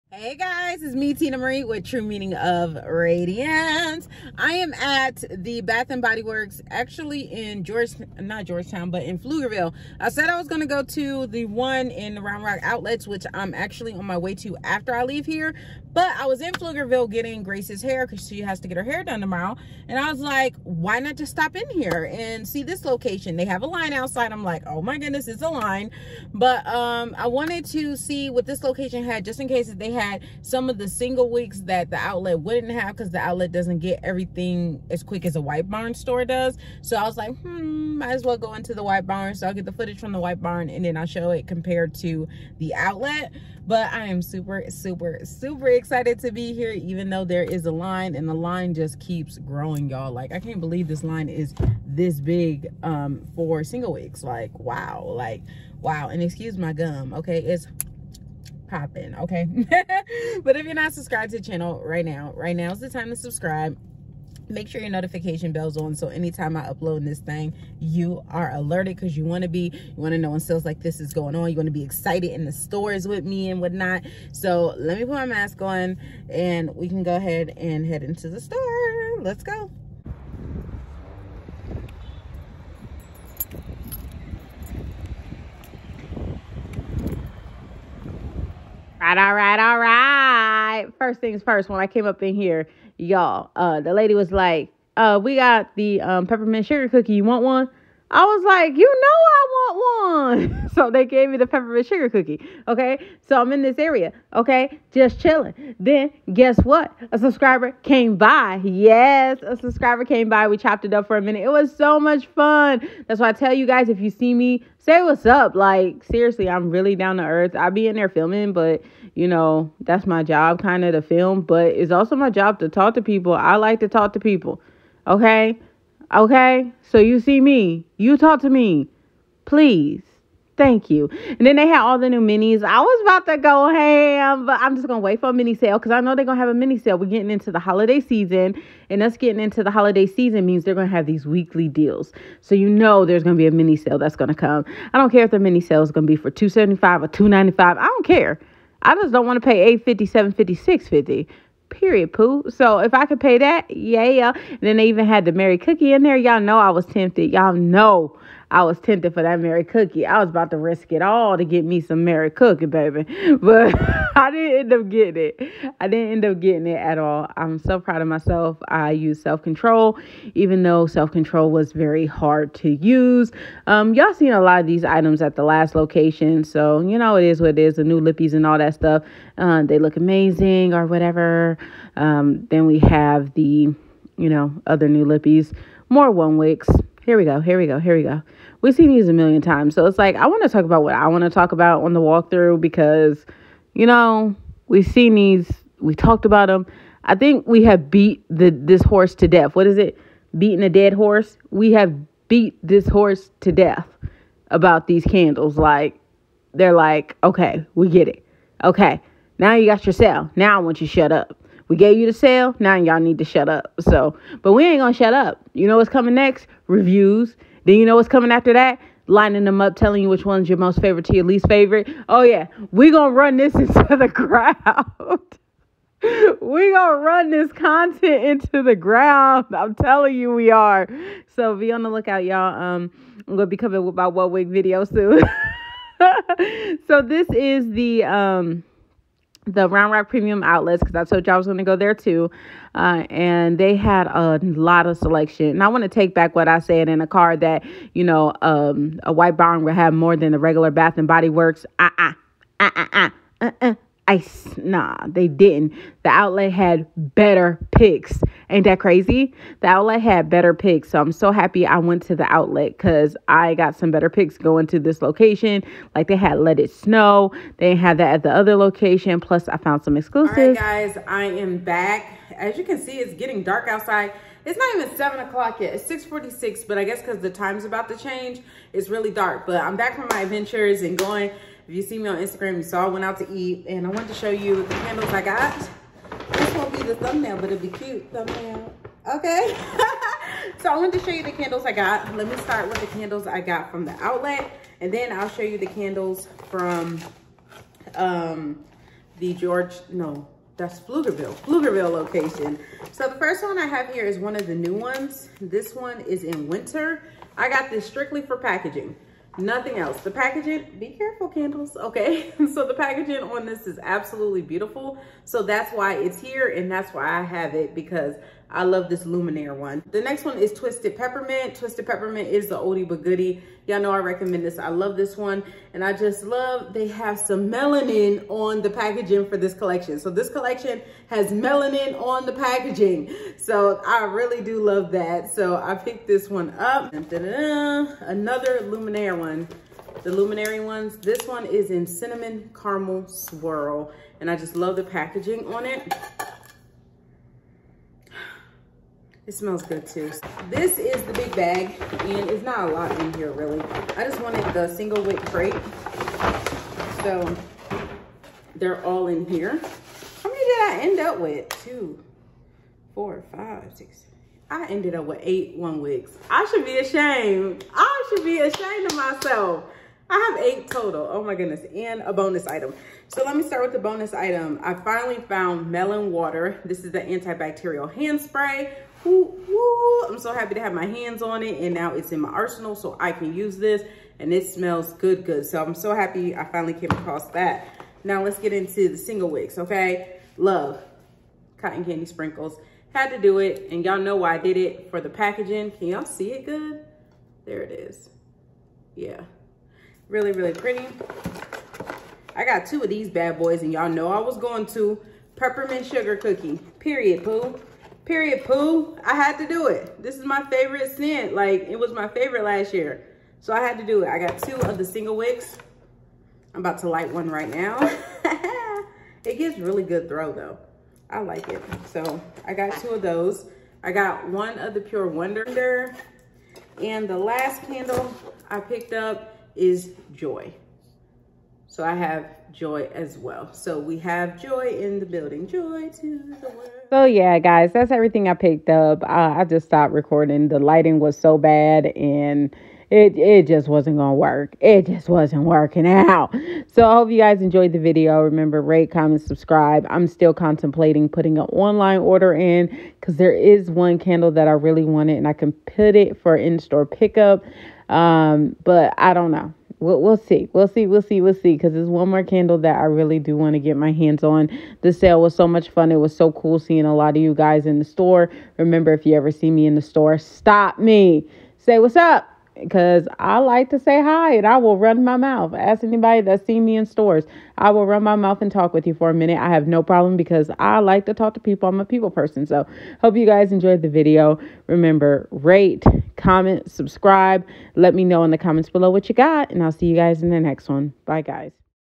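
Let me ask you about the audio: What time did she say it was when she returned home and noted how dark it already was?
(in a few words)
6:46.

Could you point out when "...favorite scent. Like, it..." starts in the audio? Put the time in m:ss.
6:50.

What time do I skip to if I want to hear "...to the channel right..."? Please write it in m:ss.
1:01.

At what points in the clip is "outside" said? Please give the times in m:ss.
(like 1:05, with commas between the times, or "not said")
0:23, 4:33.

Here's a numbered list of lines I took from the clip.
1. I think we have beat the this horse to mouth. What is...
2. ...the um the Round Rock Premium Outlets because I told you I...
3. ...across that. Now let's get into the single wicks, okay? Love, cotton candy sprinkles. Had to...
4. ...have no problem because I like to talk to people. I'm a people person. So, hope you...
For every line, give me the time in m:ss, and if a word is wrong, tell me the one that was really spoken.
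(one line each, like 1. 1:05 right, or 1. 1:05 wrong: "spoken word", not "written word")
1. 3:17 wrong: "death", not "mouth"
2. 3:57 right
3. 6:26 right
4. 7:59 right.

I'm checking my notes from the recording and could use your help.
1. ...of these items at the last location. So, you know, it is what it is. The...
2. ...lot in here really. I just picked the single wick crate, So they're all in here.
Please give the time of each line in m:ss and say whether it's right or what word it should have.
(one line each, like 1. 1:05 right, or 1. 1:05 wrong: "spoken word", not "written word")
1. 2:54 right
2. 5:52 wrong: "wanted", not "picked".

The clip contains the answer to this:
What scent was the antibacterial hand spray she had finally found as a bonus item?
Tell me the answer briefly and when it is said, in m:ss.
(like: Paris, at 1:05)
melon water, at 6:15.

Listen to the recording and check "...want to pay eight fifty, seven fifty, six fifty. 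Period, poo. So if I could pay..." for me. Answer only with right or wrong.
right.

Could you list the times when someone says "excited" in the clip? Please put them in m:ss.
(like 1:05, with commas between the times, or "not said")
0:45, 1:11.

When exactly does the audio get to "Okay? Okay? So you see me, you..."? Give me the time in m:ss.
2:05.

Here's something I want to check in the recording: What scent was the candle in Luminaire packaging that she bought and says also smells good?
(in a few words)
cinnamon caramel swirl.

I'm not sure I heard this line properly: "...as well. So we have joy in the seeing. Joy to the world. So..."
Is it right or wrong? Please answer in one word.
wrong.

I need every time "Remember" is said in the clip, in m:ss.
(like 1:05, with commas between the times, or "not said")
7:28, 7:48, 8:04.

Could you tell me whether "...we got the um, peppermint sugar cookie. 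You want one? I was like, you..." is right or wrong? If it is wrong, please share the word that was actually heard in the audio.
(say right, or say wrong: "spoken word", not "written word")
right.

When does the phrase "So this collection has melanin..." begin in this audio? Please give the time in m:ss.
5:29.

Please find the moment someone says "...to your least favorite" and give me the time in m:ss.
3:41.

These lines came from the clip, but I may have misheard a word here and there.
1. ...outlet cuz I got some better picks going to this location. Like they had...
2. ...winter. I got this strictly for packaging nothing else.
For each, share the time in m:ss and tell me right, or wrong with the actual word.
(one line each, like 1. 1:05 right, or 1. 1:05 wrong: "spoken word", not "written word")
1. 4:22 right
2. 5:06 right.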